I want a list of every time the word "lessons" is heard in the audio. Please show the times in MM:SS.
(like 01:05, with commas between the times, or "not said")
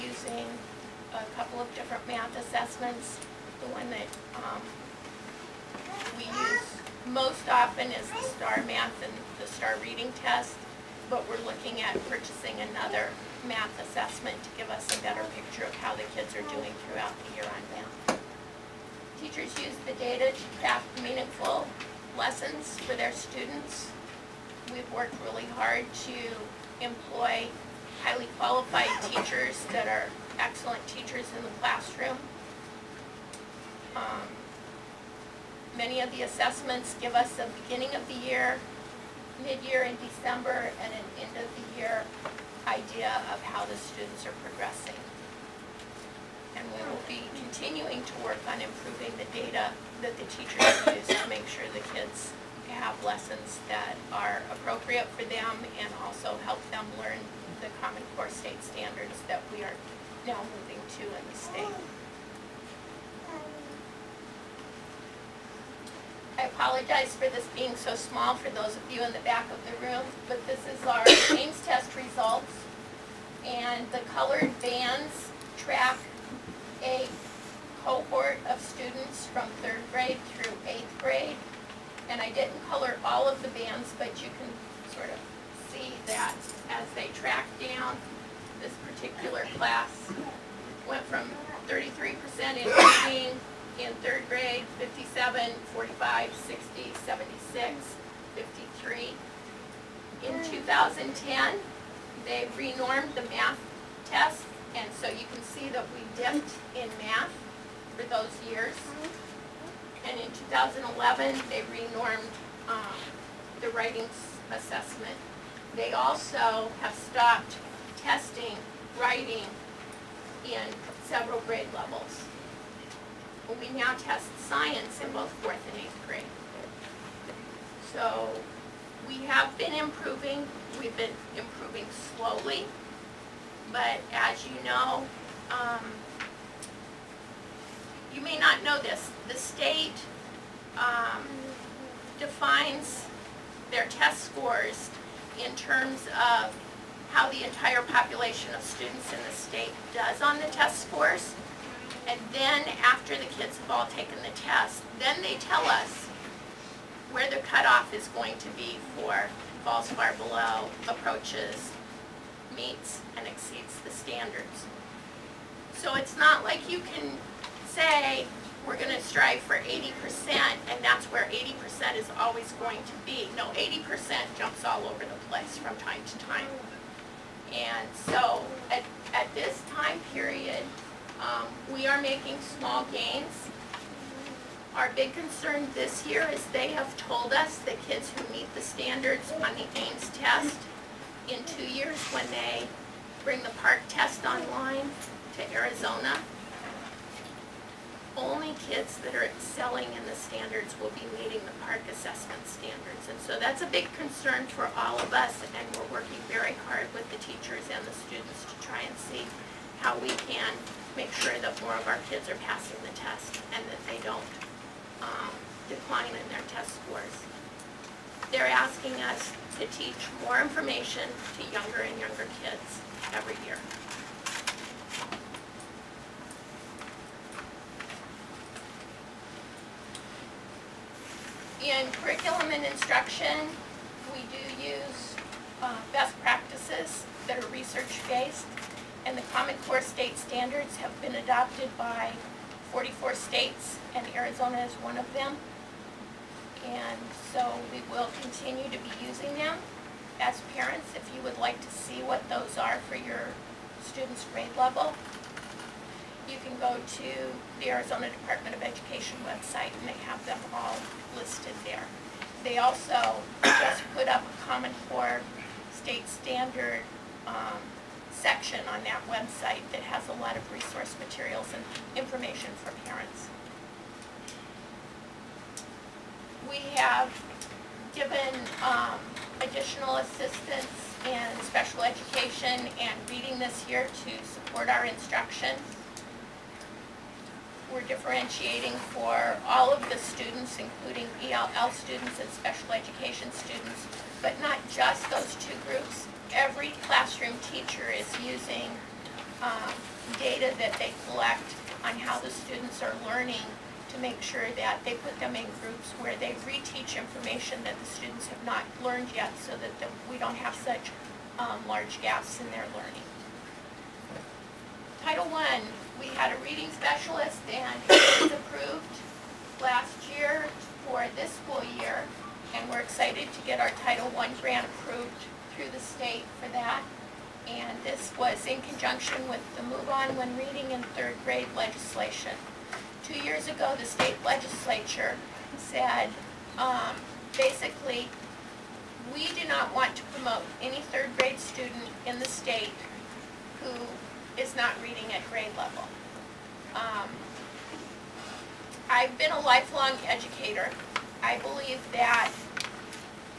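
00:22, 00:53.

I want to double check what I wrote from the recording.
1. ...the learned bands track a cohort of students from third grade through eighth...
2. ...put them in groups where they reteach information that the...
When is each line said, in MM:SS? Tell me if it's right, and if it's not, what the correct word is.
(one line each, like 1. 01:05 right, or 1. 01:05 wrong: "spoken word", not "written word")
1. 01:13 wrong: "colored", not "learned"
2. 05:04 right.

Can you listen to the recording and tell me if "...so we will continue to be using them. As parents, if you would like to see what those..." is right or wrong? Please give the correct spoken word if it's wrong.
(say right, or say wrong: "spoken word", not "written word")
right.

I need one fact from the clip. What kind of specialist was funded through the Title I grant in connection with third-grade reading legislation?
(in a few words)
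reading specialist.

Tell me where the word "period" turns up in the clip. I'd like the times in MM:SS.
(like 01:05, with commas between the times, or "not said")
03:00.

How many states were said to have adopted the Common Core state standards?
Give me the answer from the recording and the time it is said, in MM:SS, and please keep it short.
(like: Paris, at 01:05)
44, at 04:02.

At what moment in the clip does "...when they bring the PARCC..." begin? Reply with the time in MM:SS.
03:12.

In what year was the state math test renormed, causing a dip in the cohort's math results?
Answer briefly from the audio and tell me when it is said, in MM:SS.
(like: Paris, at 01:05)
2010, at 01:40.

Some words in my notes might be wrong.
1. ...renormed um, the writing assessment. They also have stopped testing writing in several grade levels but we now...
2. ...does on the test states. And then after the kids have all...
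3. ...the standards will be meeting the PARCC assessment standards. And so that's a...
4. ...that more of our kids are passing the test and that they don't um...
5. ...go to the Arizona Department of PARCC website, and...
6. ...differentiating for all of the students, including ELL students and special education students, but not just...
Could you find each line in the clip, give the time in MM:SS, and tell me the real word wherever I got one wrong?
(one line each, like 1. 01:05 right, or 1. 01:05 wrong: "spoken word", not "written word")
1. 01:51 right
2. 02:29 wrong: "scores", not "states"
3. 03:20 right
4. 03:31 right
5. 04:16 wrong: "Education", not "PARCC"
6. 04:47 right.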